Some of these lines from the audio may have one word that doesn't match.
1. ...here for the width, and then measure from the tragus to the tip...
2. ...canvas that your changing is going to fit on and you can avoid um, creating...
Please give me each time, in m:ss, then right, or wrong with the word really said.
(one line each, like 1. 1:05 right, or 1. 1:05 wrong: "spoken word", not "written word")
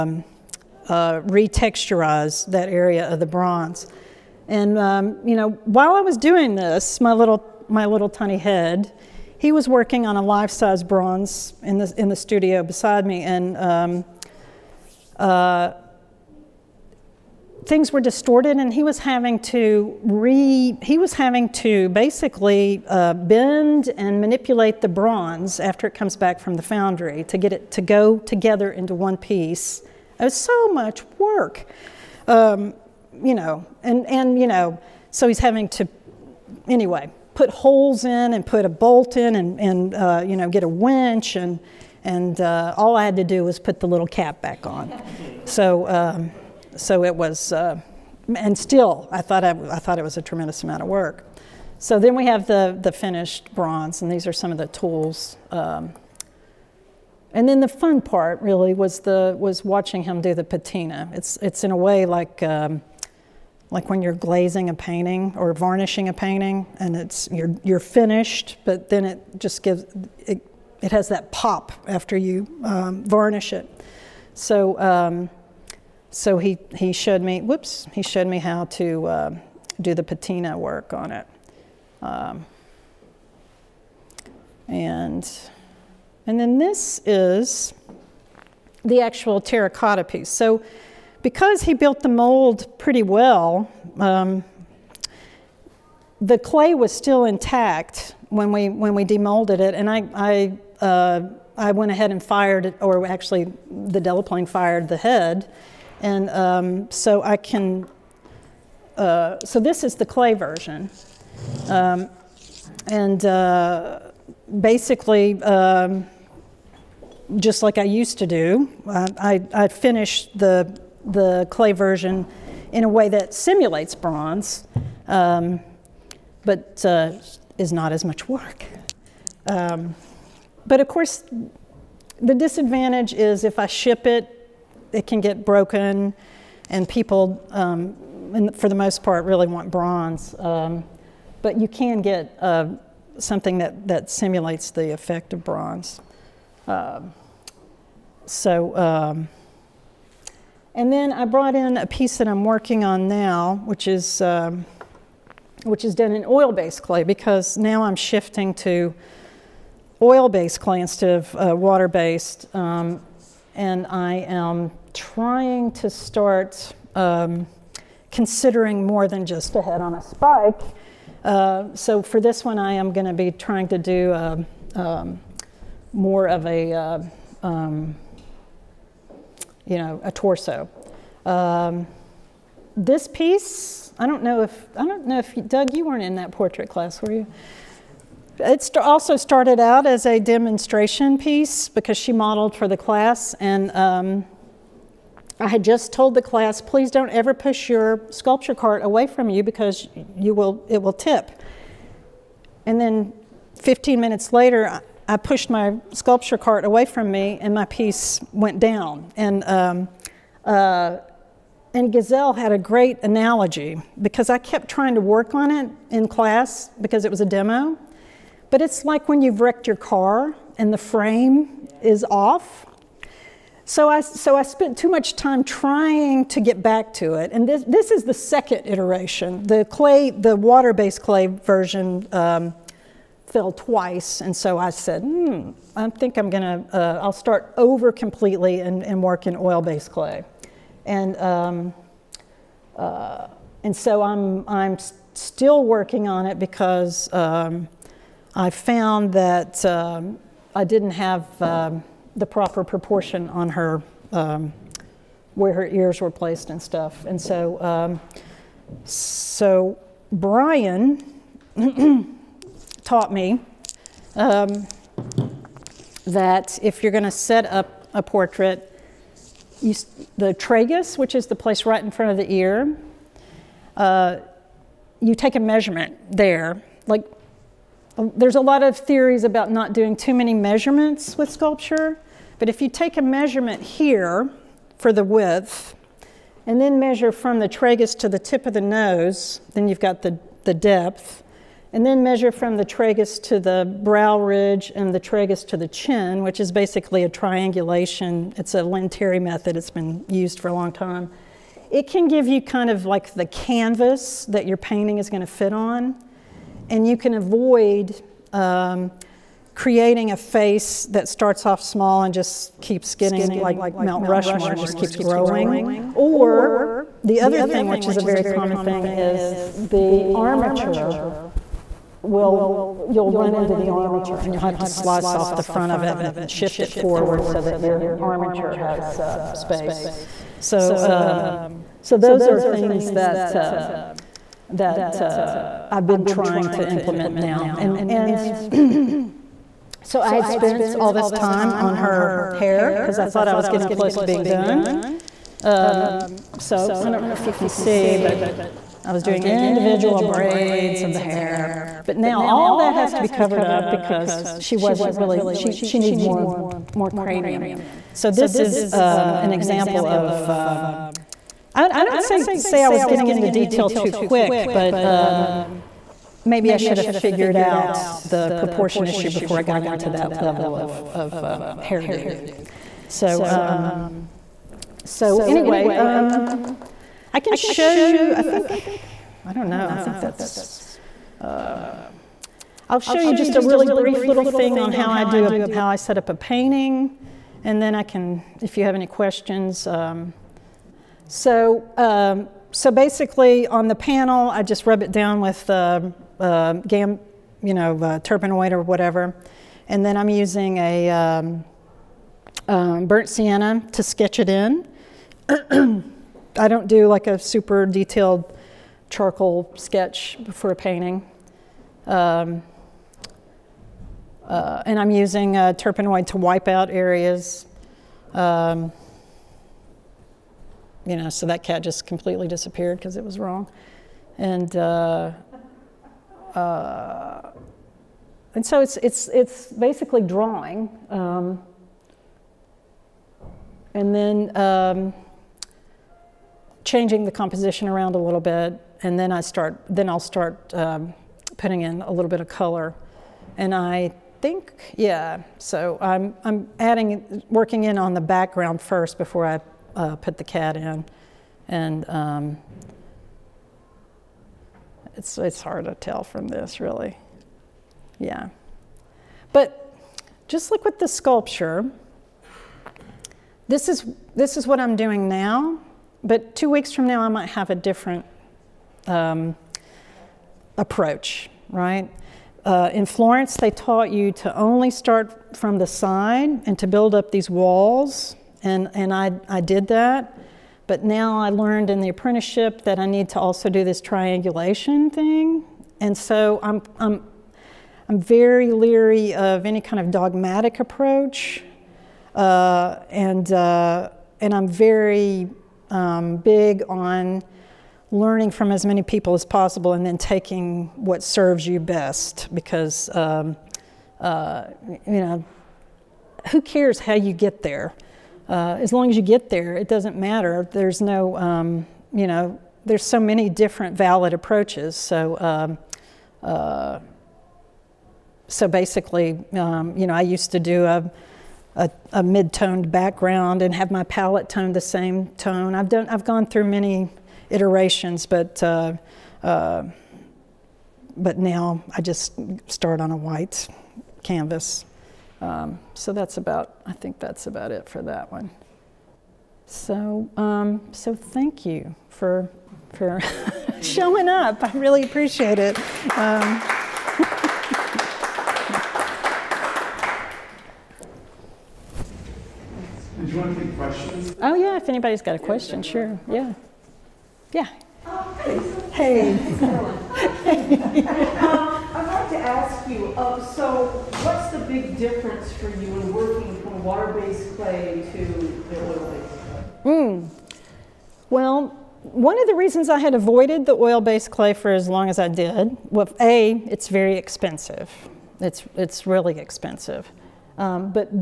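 1. 4:43 right
2. 5:03 wrong: "painting", not "changing".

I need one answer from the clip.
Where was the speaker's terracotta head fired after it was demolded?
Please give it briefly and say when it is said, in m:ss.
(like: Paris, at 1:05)
the Delaplaine, at 1:43.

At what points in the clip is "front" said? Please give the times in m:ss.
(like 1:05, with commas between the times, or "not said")
4:31, 5:25.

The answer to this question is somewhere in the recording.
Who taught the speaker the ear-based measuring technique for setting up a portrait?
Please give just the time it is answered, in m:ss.
4:20.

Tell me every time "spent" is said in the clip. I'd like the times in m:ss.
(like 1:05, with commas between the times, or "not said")
3:44, 5:40.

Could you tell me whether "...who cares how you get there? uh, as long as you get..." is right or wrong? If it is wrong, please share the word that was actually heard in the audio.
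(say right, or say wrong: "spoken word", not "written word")
right.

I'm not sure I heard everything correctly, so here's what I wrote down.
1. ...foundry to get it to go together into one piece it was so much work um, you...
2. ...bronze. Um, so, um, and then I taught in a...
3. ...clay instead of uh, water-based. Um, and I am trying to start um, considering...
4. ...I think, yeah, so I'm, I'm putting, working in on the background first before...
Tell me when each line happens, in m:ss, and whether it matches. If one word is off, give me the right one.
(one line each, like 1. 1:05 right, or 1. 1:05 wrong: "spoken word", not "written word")
1. 0:26 right
2. 2:25 wrong: "brought", not "taught"
3. 2:40 right
4. 7:23 wrong: "adding", not "putting".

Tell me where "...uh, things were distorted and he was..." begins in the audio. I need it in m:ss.
0:15.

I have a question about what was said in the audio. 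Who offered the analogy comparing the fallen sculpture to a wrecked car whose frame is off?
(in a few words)
Gazelle.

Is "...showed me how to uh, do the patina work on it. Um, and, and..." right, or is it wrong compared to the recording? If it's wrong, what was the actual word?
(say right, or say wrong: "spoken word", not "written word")
right.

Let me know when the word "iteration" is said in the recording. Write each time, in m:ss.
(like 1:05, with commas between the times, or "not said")
3:48, 8:47.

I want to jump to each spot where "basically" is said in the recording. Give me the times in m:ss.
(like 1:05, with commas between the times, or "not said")
0:21, 1:54, 4:56, 6:32, 7:09, 8:38.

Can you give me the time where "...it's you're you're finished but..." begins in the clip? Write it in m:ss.
1:06.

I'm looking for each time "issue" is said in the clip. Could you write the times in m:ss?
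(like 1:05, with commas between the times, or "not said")
6:08.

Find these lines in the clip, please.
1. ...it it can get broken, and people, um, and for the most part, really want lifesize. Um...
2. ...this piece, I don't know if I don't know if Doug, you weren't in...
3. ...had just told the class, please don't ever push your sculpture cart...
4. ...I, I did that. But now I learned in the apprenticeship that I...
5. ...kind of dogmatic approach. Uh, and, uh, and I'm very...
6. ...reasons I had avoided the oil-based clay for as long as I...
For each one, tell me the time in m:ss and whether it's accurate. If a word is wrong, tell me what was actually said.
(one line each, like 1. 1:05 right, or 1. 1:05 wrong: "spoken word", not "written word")
1. 2:14 wrong: "bronze", not "lifesize"
2. 3:02 right
3. 3:15 right
4. 7:58 right
5. 8:09 right
6. 9:32 right.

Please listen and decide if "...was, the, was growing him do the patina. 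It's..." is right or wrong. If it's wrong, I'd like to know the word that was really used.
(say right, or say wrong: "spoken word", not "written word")
wrong: "watching", not "growing".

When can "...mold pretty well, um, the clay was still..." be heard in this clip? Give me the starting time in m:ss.
1:32.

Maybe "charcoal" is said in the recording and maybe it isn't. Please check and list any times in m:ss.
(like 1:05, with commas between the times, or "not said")
6:48.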